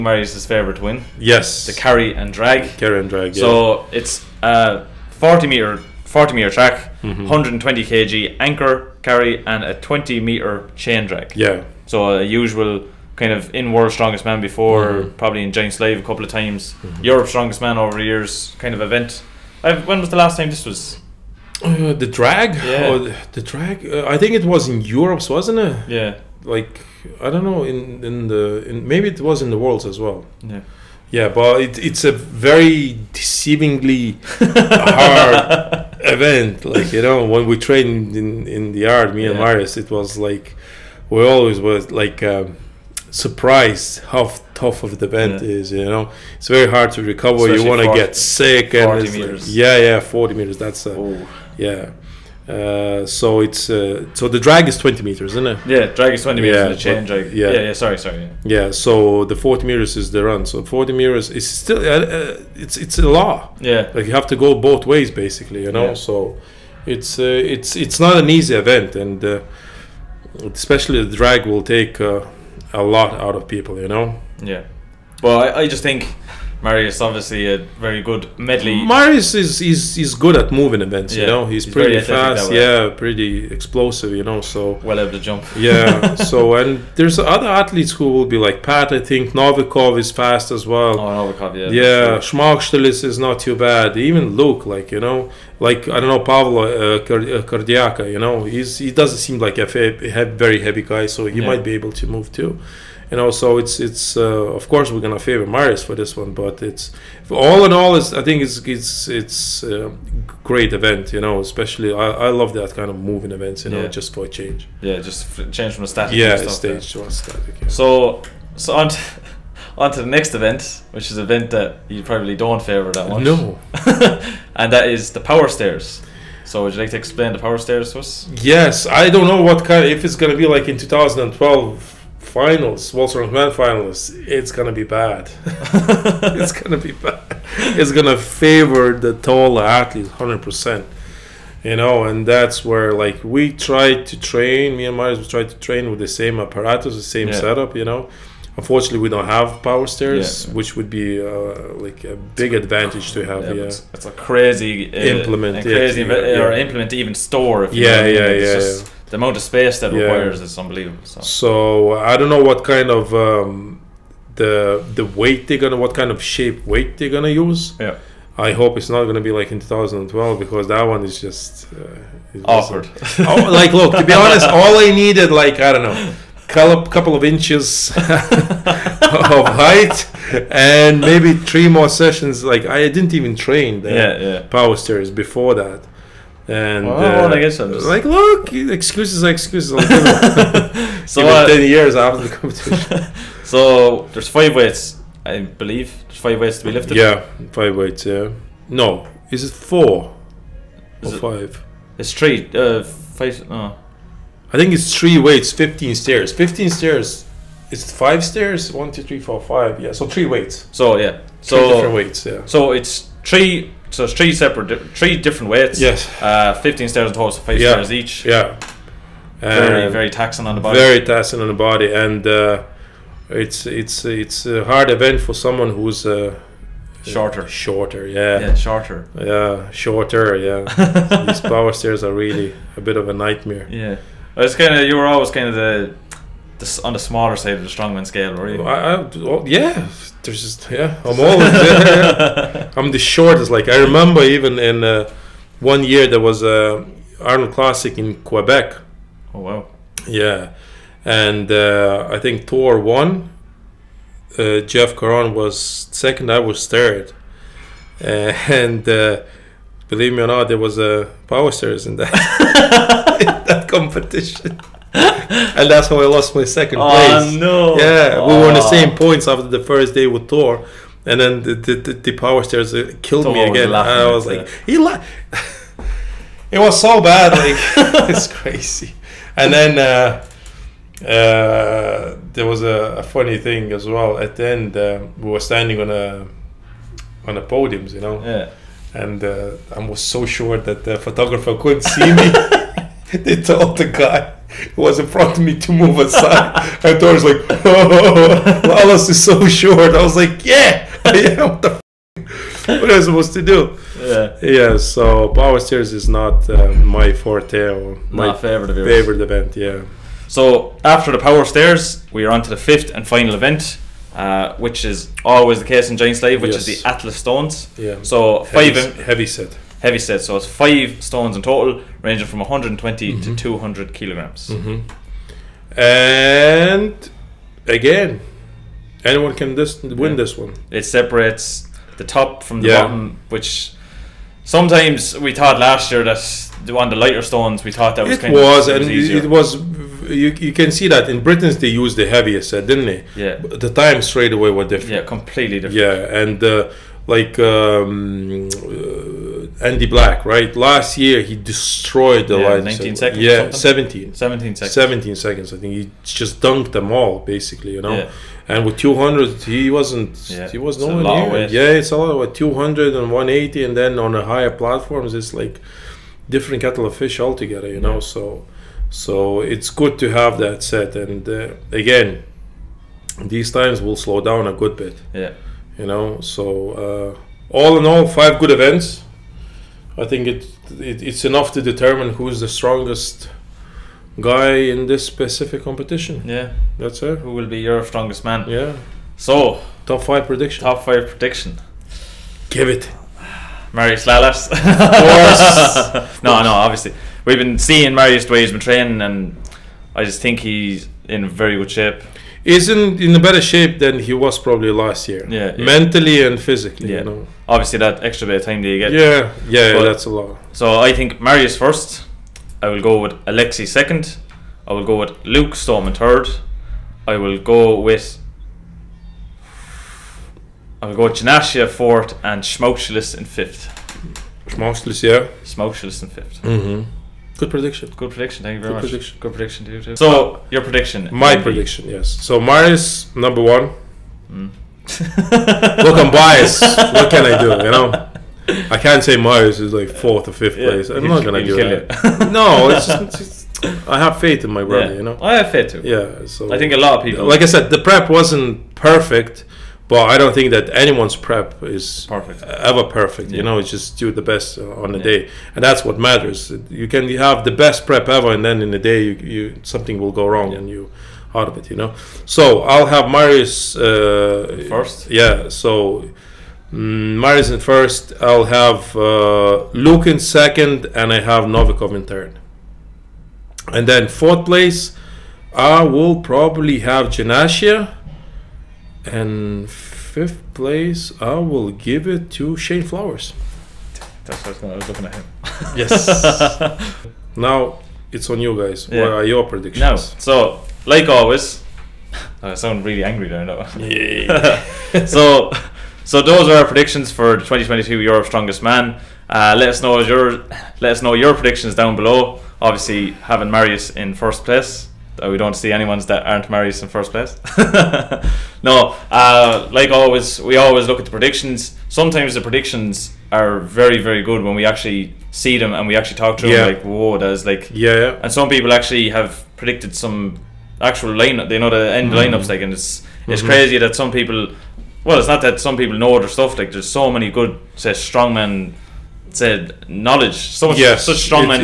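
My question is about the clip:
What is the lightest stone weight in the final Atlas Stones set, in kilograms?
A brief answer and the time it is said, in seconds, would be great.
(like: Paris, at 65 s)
120, at 322 s.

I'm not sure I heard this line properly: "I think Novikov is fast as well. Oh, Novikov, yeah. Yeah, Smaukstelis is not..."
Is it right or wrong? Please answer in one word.
right.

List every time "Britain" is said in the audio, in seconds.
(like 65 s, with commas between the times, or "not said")
341 s.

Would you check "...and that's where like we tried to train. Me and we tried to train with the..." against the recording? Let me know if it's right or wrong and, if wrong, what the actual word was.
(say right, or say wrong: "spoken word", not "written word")
right.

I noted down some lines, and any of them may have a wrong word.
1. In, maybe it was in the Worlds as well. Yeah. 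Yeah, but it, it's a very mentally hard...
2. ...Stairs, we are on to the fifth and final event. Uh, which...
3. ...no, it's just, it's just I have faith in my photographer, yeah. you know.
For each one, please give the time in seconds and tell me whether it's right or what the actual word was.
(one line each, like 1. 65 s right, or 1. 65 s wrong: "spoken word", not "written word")
1. 28 s wrong: "deceivingly", not "mentally"
2. 311 s right
3. 442 s wrong: "brother", not "photographer".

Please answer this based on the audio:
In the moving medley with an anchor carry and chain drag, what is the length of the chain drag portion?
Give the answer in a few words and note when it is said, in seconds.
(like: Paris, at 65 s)
20 meters, at 9 s.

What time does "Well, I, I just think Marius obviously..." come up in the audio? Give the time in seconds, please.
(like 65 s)
75 s.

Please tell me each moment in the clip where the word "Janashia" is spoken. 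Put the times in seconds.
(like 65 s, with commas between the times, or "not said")
421 s, 477 s.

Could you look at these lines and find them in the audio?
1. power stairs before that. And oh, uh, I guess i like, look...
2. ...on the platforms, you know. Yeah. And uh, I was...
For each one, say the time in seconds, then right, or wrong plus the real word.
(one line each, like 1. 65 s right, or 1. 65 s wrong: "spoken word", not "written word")
1. 184 s right
2. 287 s wrong: "podiums", not "platforms".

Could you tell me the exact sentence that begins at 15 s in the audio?
probably in Giants Live a couple of times.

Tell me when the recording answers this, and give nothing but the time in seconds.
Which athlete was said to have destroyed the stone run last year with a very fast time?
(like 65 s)
349 s.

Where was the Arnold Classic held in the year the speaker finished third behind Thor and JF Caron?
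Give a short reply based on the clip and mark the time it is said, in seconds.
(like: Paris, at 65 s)
Quebec, at 248 s.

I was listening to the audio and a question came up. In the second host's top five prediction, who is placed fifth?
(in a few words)
Shane Flowers.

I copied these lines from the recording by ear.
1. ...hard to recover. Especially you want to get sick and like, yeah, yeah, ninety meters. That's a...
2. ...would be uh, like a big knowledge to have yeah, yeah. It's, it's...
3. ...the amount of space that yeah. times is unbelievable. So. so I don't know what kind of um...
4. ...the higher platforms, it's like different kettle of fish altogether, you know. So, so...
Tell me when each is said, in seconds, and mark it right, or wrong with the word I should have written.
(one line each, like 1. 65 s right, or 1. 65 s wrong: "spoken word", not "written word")
1. 46 s wrong: "forty", not "ninety"
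2. 150 s wrong: "advantage", not "knowledge"
3. 159 s wrong: "requires", not "times"
4. 364 s right.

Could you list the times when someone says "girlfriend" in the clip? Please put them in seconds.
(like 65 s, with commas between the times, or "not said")
not said.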